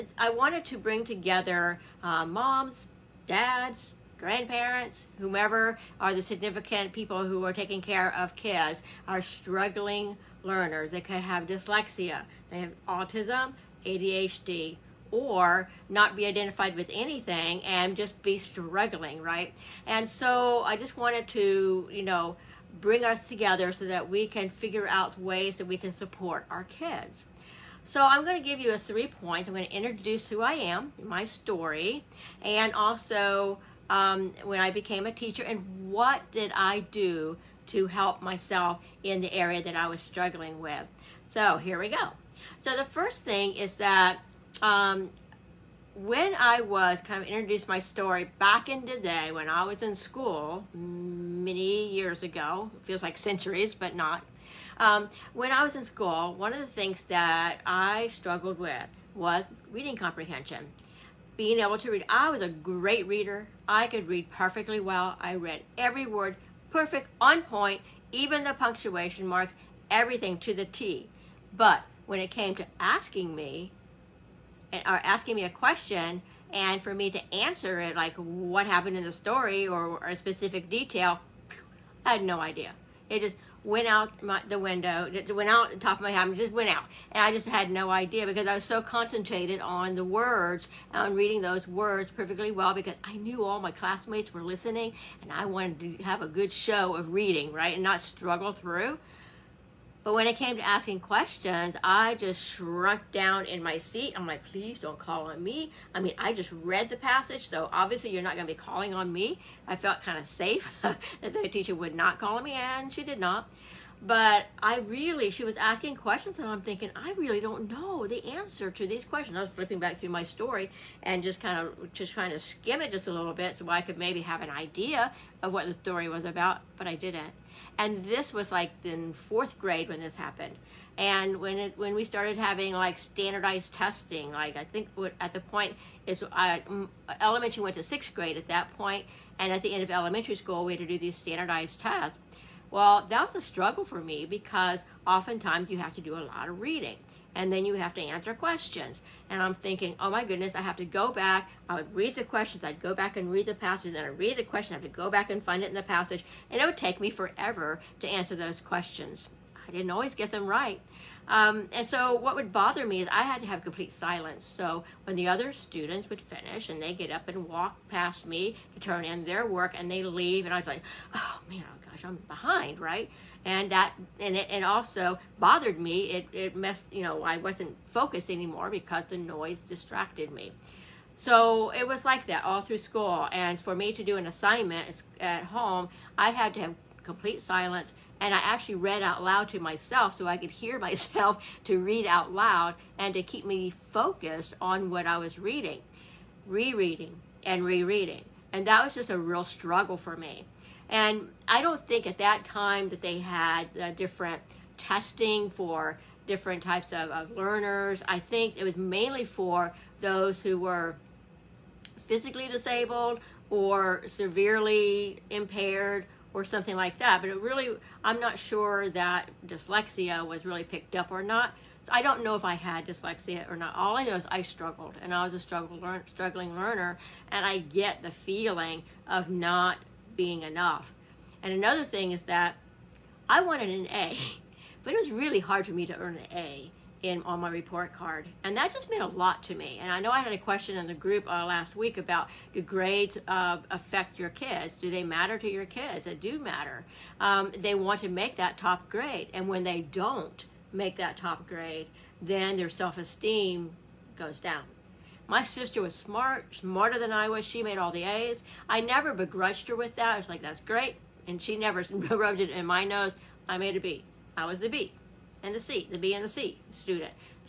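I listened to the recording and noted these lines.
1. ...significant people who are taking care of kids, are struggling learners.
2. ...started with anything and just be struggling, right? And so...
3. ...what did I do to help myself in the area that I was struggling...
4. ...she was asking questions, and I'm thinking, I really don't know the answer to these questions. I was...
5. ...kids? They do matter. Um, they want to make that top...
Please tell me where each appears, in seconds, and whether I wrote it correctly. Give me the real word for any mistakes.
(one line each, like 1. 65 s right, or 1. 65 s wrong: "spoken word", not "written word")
1. 6 s right
2. 16 s wrong: "identified", not "started"
3. 35 s right
4. 115 s right
5. 245 s right.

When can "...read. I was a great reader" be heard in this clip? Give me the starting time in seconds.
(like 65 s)
61 s.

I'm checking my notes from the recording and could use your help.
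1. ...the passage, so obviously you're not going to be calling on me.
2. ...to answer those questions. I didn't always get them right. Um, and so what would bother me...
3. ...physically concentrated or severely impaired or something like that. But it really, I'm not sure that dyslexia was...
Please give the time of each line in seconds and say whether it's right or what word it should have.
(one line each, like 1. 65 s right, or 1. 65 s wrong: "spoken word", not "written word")
1. 106 s right
2. 157 s right
3. 212 s wrong: "disabled", not "concentrated".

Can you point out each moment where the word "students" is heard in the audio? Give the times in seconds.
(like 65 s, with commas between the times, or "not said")
165 s, 266 s.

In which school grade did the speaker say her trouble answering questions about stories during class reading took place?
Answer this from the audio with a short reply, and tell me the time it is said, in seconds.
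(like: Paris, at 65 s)
Fourth grade, at 129 s.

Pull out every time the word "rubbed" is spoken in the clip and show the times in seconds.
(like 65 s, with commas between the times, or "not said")
261 s.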